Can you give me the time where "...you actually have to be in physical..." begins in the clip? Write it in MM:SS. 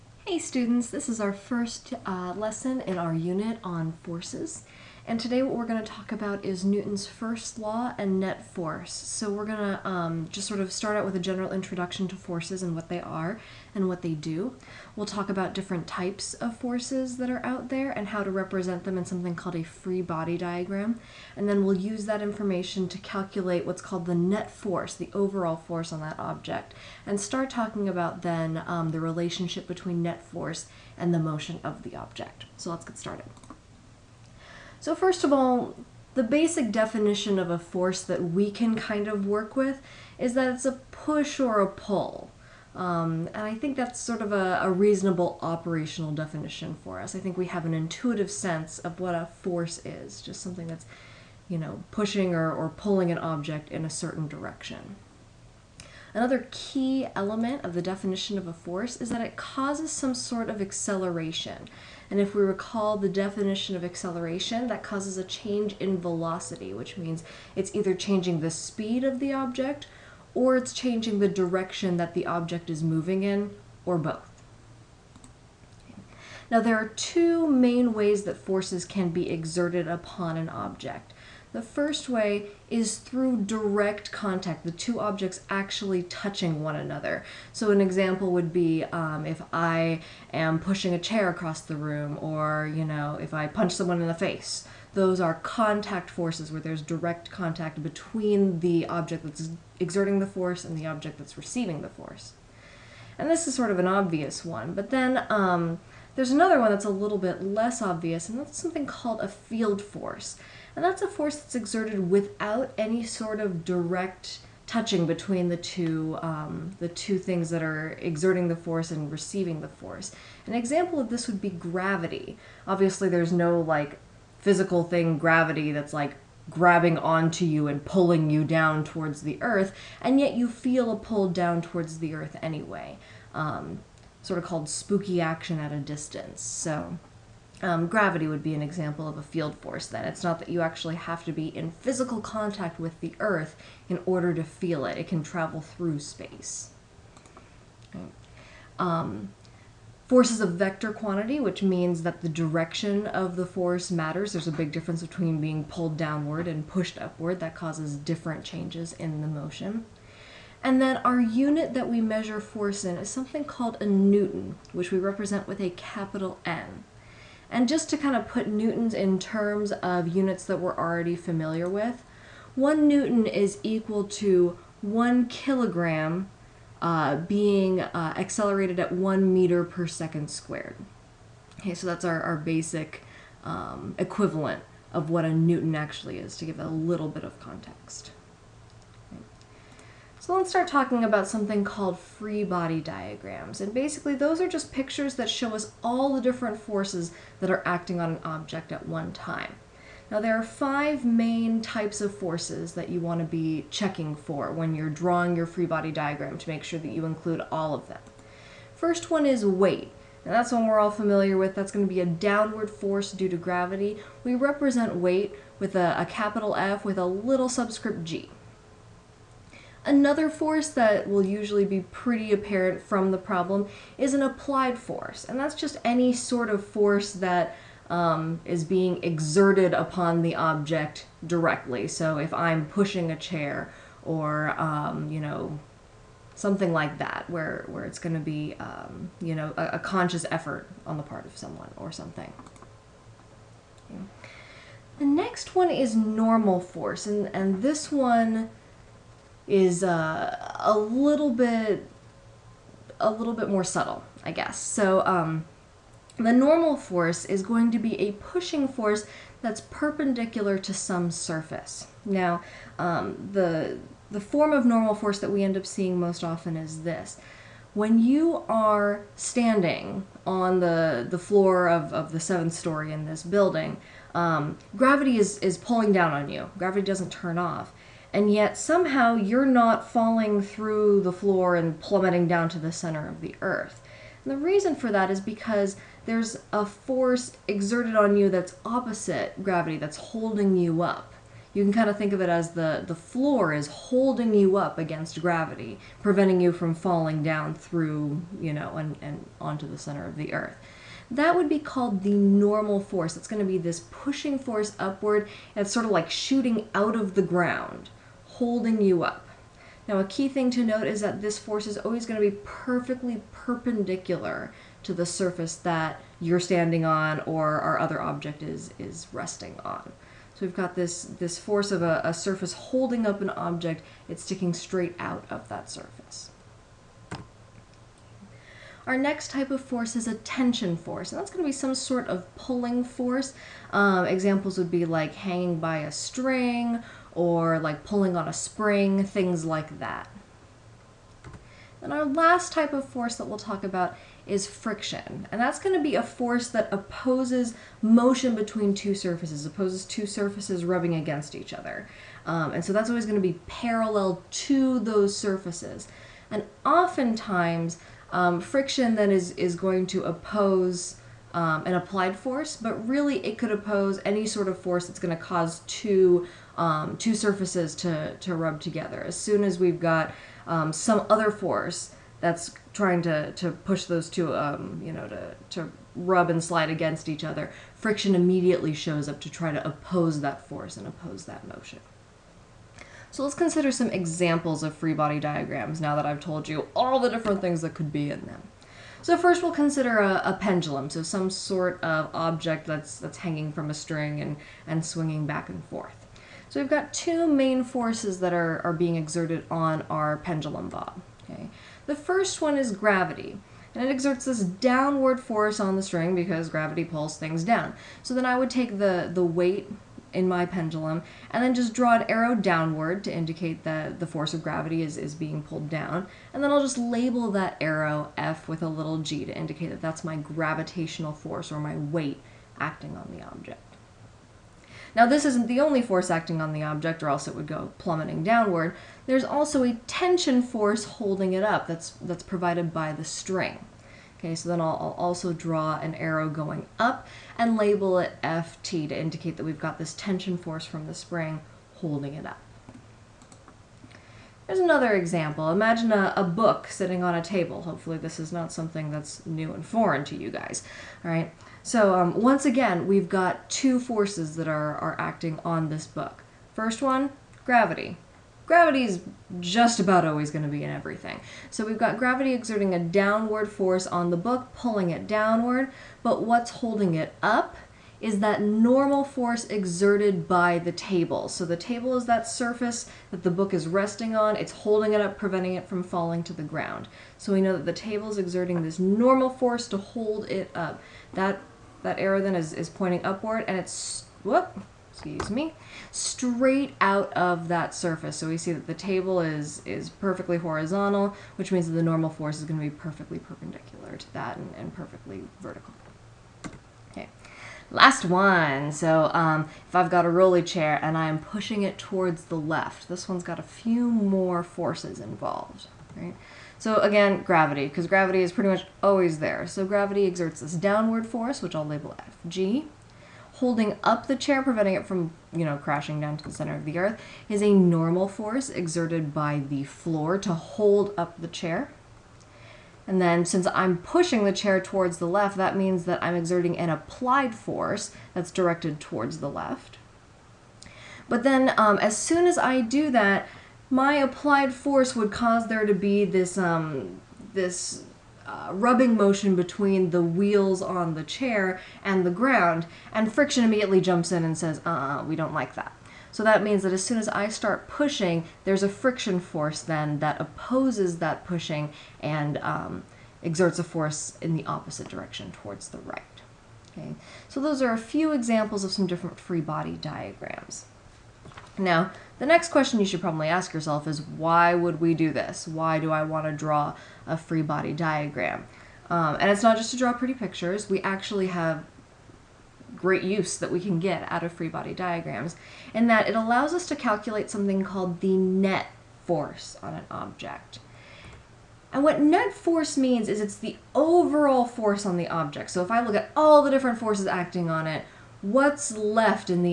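02:20.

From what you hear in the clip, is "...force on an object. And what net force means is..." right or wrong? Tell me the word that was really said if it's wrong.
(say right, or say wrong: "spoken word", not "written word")
right.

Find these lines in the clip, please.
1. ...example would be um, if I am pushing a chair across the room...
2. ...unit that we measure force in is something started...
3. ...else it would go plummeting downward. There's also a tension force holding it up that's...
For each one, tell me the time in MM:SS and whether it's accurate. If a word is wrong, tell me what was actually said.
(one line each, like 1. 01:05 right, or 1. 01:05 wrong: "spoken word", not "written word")
1. 01:27 right
2. 02:41 wrong: "called", not "started"
3. 07:07 right.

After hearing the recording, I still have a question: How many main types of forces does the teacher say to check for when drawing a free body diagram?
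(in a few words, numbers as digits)
5.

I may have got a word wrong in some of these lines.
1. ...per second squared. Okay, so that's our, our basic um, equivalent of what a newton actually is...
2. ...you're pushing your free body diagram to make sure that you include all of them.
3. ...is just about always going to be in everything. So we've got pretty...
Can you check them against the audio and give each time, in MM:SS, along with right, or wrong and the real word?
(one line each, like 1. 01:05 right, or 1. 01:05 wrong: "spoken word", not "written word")
1. 02:59 right
2. 03:24 wrong: "drawing", not "pushing"
3. 07:38 wrong: "gravity", not "pretty".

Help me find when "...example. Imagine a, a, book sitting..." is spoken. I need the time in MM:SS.
07:24.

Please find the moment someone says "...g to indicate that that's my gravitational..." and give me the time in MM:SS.
06:58.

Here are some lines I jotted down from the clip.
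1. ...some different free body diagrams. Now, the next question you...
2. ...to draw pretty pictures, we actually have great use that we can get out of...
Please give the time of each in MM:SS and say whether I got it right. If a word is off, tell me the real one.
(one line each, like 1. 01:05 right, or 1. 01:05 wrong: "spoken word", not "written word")
1. 09:18 right
2. 09:29 right.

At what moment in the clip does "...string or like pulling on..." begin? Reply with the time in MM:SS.
05:35.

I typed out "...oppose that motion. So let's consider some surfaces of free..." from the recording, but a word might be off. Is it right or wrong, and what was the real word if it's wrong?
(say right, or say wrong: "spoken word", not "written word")
wrong: "examples", not "surfaces".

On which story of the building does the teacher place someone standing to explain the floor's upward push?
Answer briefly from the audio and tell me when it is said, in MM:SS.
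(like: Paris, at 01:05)
seventh, at 04:32.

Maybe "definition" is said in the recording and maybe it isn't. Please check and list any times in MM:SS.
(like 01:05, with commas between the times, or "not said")
00:36, 00:46, 00:57, 01:03.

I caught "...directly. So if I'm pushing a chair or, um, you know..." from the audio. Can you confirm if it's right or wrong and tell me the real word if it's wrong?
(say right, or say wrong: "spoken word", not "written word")
right.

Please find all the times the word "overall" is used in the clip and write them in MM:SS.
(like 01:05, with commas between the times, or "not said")
00:25, 09:43.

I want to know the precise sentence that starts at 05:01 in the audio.
That would be called the normal force.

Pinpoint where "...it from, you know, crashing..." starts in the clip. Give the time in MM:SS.
08:34.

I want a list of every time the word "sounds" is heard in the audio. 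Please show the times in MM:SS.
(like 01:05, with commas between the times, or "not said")
not said.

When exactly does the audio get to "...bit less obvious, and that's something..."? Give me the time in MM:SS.
01:47.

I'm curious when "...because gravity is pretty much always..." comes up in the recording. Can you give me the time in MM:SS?
08:27.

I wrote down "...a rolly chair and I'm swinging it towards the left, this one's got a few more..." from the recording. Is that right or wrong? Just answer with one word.
wrong.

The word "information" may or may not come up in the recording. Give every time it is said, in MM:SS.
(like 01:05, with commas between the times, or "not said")
00:22.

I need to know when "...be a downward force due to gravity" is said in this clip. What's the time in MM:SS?
03:31.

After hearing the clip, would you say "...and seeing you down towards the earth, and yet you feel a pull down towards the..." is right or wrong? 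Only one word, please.
wrong.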